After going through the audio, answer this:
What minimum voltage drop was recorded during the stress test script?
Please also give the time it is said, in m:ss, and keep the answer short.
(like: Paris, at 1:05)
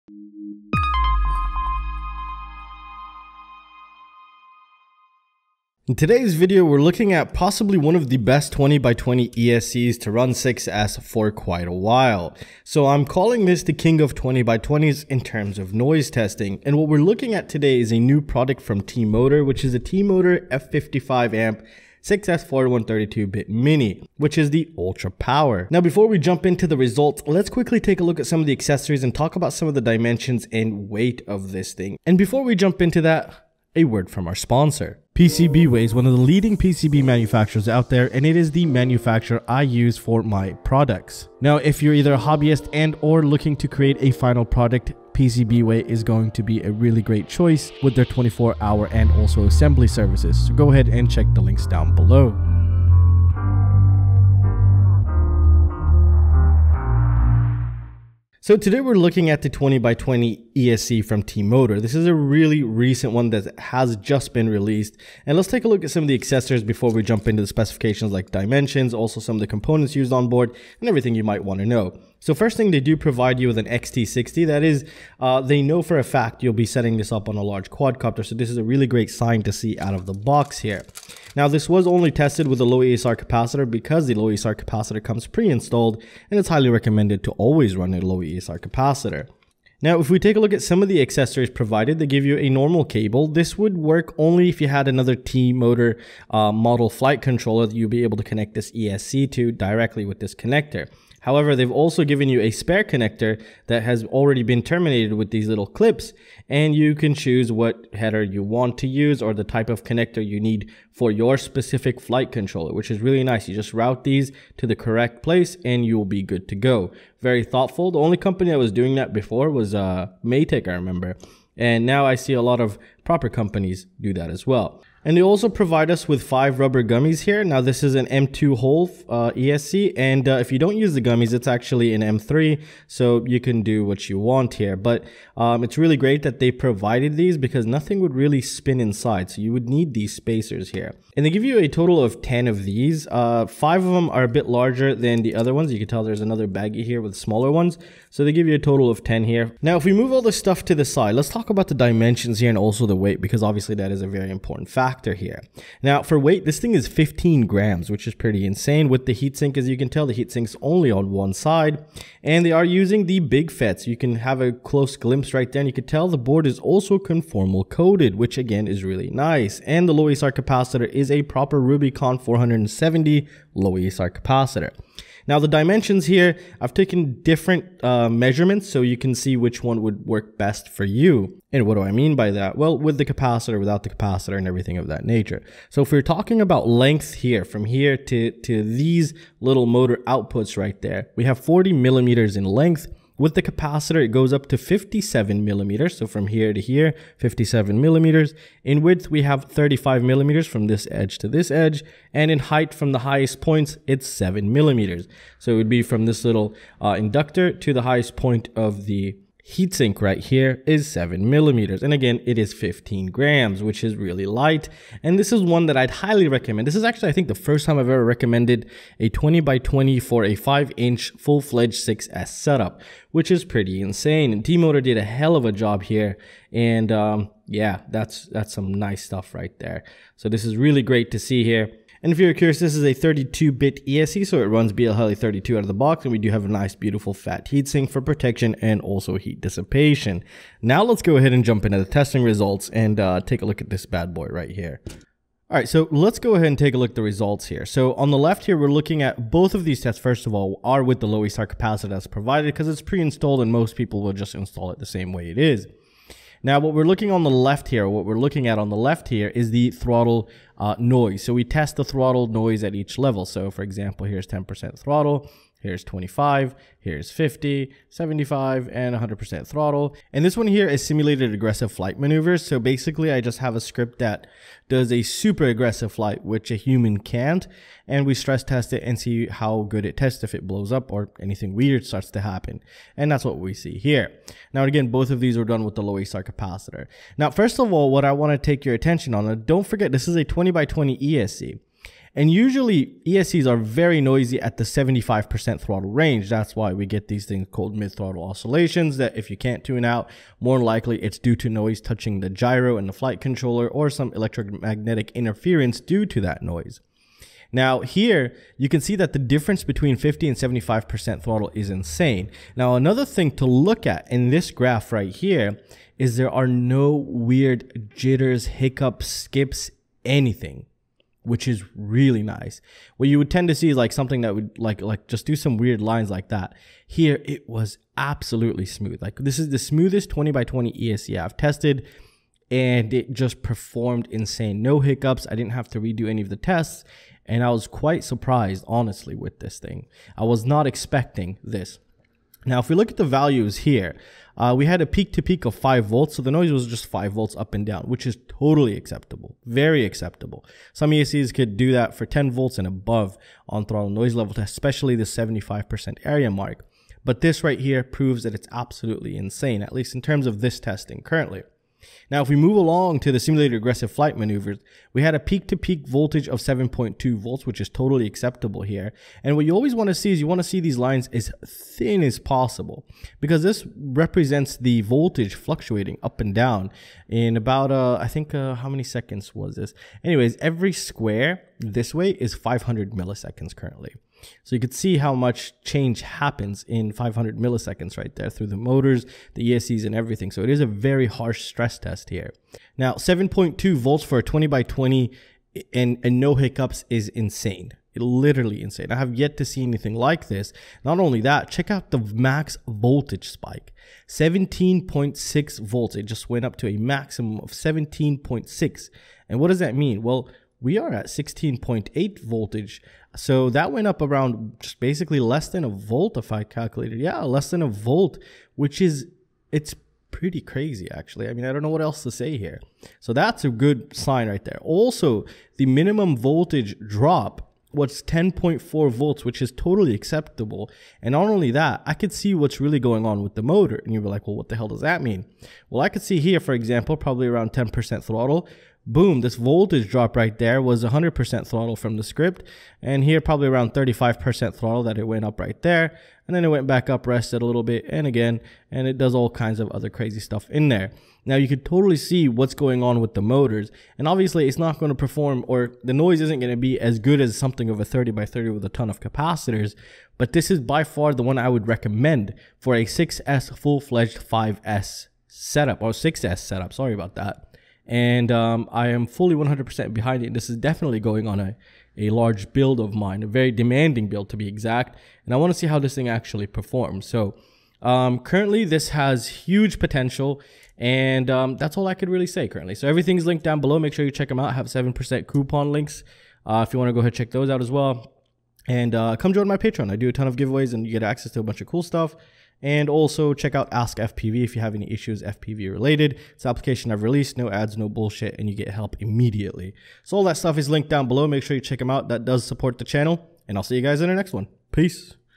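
10.4 volts, at 7:08.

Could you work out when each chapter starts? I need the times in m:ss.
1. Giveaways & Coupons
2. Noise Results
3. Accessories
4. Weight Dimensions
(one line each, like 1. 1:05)
1. 8:02
2. 4:04
3. 0:35
4. 2:32.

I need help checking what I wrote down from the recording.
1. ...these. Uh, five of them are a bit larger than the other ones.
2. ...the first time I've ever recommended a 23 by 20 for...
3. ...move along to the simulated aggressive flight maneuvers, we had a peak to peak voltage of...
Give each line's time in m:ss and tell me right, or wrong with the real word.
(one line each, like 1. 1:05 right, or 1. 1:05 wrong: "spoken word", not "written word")
1. 2:22 right
2. 3:37 wrong: "20", not "23"
3. 6:02 right.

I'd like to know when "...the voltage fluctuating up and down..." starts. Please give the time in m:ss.
6:14.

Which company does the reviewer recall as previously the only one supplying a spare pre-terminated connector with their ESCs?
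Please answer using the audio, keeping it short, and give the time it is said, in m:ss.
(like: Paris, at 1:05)
Matek, at 2:00.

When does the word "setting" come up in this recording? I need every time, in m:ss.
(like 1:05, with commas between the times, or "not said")
1:16.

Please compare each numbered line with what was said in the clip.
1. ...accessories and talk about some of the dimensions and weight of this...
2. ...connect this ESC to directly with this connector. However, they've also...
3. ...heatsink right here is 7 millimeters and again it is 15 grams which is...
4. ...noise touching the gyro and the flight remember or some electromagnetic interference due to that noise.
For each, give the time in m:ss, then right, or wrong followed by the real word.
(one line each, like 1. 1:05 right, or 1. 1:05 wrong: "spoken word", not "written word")
1. 0:28 right
2. 1:38 right
3. 3:29 right
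4. 5:01 wrong: "controller", not "remember".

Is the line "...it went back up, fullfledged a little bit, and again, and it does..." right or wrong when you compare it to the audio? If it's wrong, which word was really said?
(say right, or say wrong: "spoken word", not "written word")
wrong: "rested", not "fullfledged".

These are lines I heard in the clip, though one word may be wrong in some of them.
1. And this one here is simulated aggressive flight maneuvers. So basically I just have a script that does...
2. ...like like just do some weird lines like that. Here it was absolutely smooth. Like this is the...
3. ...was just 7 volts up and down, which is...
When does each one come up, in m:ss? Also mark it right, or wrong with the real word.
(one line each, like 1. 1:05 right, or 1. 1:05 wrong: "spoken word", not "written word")
1. 4:30 right
2. 5:24 right
3. 5:46 wrong: "5", not "7".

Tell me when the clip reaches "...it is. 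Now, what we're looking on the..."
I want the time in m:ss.
4:15.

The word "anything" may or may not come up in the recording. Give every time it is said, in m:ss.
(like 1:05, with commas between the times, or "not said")
4:41, 5:20, 6:39.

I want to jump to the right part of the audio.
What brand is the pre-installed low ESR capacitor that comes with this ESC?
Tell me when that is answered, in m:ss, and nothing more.
2:51.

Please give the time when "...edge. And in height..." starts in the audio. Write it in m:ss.
3:21.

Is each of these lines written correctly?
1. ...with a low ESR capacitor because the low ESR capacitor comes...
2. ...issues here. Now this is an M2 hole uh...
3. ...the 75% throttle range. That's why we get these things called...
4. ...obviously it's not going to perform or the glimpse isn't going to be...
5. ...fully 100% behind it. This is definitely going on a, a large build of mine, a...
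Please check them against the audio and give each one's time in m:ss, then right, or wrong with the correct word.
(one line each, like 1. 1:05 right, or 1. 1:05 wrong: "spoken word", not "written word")
1. 1:22 right
2. 2:06 wrong: "gummies", not "issues"
3. 4:54 right
4. 7:34 wrong: "noise", not "glimpse"
5. 7:49 right.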